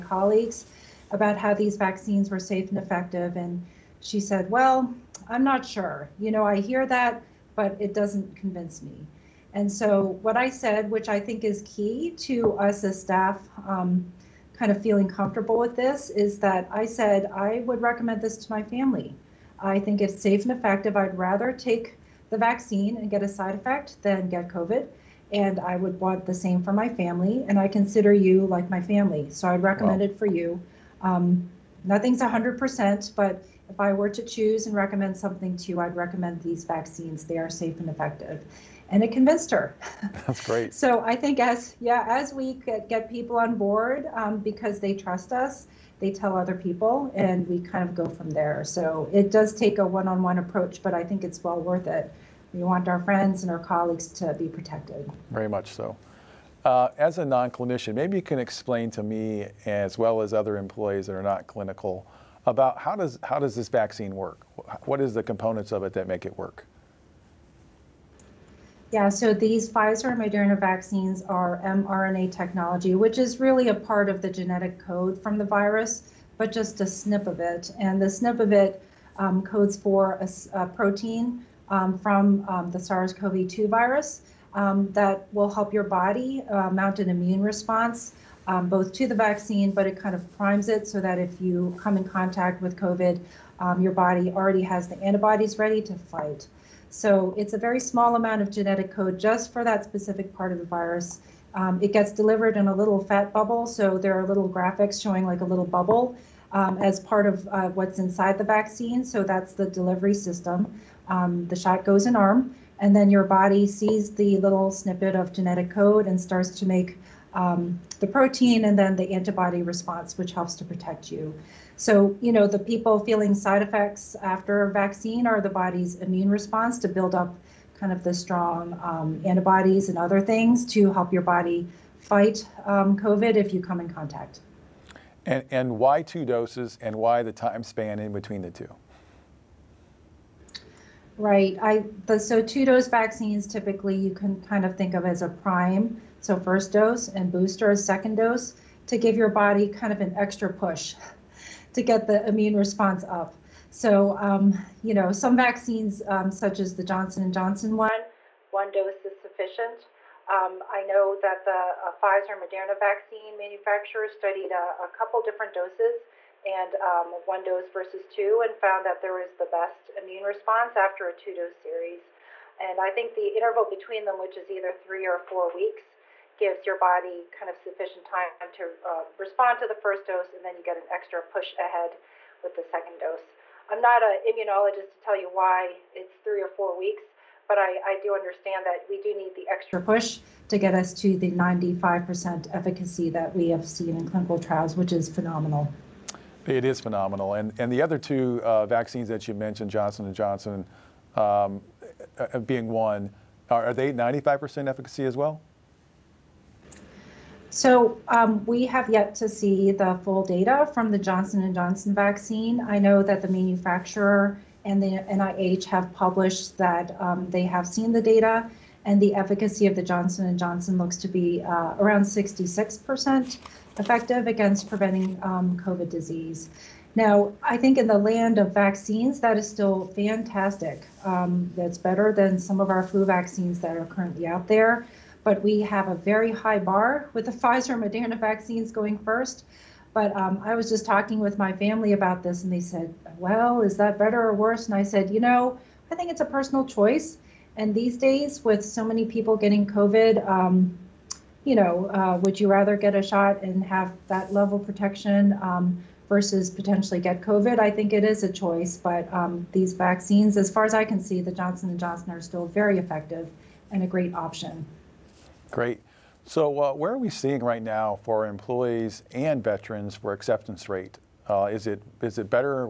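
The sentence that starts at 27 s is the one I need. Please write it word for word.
And I consider you like my family.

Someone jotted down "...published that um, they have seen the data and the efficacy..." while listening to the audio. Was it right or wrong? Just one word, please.
right.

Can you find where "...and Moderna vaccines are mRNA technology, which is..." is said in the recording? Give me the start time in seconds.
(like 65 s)
70 s.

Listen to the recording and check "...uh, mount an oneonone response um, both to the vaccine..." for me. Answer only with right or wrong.
wrong.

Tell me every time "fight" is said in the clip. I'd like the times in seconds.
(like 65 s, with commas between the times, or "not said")
95 s, 131 s.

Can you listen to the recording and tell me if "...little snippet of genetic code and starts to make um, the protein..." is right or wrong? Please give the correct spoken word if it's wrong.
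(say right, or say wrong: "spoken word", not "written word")
right.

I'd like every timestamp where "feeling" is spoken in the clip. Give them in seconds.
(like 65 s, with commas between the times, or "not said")
14 s, 122 s.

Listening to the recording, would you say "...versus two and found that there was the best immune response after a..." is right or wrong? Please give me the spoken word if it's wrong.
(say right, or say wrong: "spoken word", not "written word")
right.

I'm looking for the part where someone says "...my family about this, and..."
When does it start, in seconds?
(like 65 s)
241 s.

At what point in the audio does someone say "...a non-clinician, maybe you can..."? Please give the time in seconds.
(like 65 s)
57 s.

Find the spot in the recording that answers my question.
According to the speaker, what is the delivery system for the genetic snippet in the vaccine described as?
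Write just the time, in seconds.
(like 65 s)
102 s.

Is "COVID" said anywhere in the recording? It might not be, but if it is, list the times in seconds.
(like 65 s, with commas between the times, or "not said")
24 s, 92 s, 132 s, 225 s, 249 s, 257 s.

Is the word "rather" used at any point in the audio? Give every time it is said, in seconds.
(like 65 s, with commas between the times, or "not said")
21 s, 252 s.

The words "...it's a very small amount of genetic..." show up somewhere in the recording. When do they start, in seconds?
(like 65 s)
97 s.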